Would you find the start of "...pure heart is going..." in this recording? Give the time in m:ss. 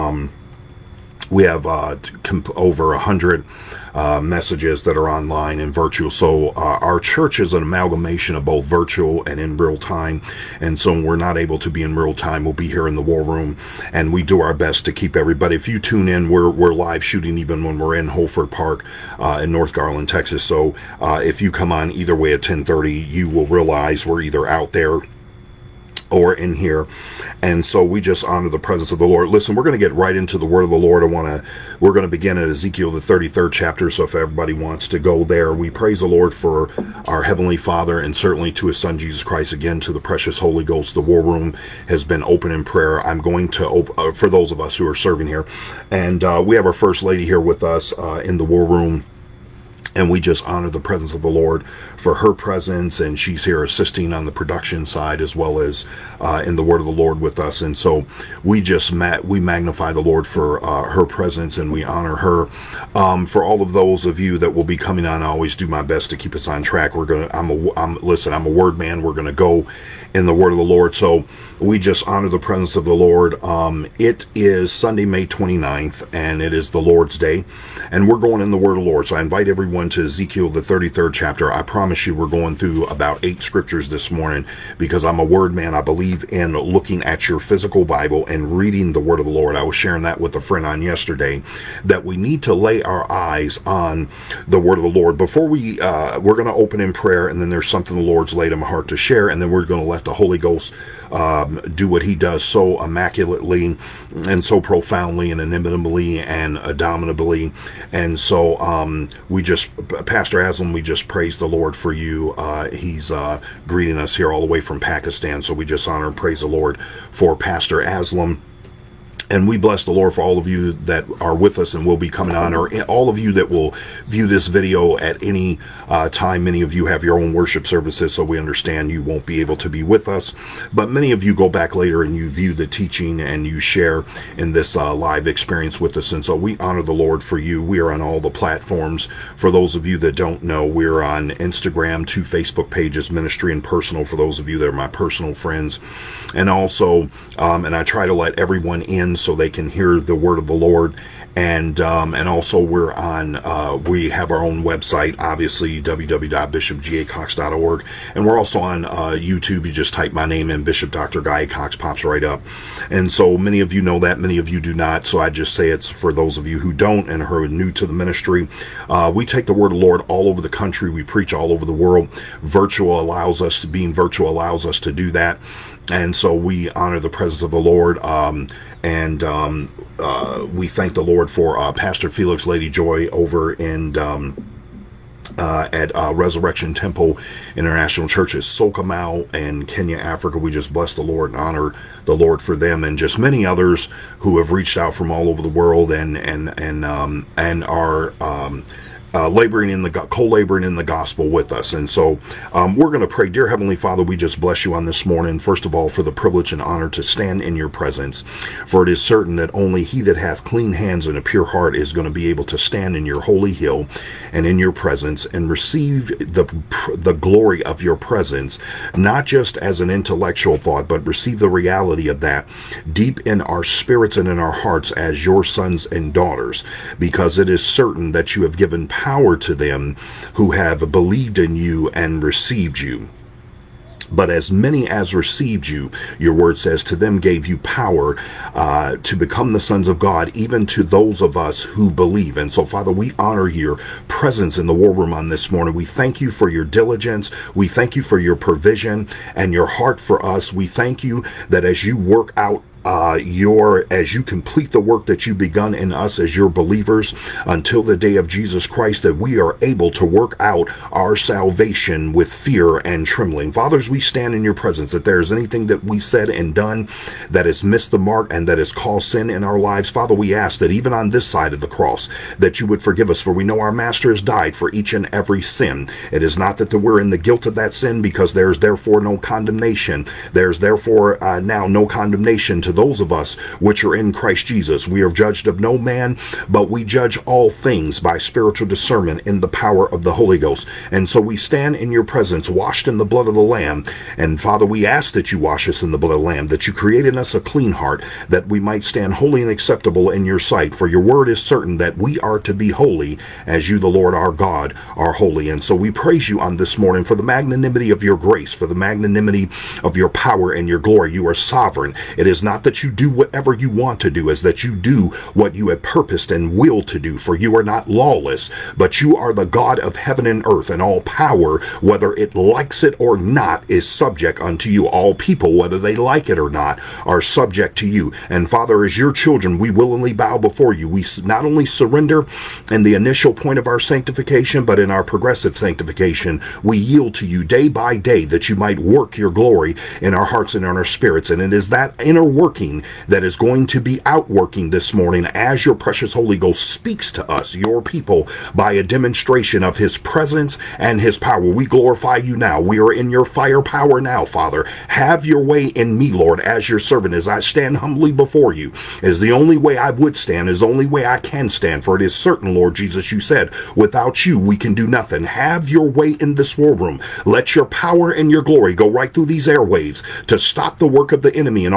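3:31.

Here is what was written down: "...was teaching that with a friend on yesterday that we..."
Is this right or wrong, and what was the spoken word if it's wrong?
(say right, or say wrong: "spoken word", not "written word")
wrong: "sharing", not "teaching".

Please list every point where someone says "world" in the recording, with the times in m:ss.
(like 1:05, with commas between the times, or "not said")
2:51, 3:15.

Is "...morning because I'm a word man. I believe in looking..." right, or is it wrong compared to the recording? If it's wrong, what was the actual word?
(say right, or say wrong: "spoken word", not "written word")
right.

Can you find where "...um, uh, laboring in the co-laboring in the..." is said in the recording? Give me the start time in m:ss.
3:18.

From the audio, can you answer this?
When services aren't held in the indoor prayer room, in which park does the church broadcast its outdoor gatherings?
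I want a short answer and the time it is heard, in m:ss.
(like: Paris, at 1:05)
Holford Park, at 0:18.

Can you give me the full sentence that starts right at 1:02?
Um, for all of those of you that will be coming on, I always do my best to keep us on track.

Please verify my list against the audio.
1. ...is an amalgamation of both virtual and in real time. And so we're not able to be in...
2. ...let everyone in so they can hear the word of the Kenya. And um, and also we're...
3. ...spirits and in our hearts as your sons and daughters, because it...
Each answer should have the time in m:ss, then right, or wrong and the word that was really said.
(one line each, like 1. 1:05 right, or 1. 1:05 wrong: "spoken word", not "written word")
1. 0:07 right
2. 2:28 wrong: "Lord", not "Kenya"
3. 3:43 right.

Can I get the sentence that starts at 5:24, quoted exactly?
All people, whether they like it or not, are subject to you.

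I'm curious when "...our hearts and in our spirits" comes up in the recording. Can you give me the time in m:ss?
5:40.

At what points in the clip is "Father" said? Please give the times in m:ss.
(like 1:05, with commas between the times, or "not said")
0:37, 3:23, 4:02, 4:23, 4:29, 4:54, 5:28, 5:54.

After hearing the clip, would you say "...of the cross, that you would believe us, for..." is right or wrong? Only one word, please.
wrong.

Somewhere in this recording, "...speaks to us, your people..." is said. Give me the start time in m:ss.
5:46.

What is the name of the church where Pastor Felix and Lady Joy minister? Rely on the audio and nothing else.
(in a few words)
Resurrection Temple International Churches.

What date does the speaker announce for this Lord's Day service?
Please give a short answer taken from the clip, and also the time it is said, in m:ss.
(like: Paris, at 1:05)
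May 29, at 1:15.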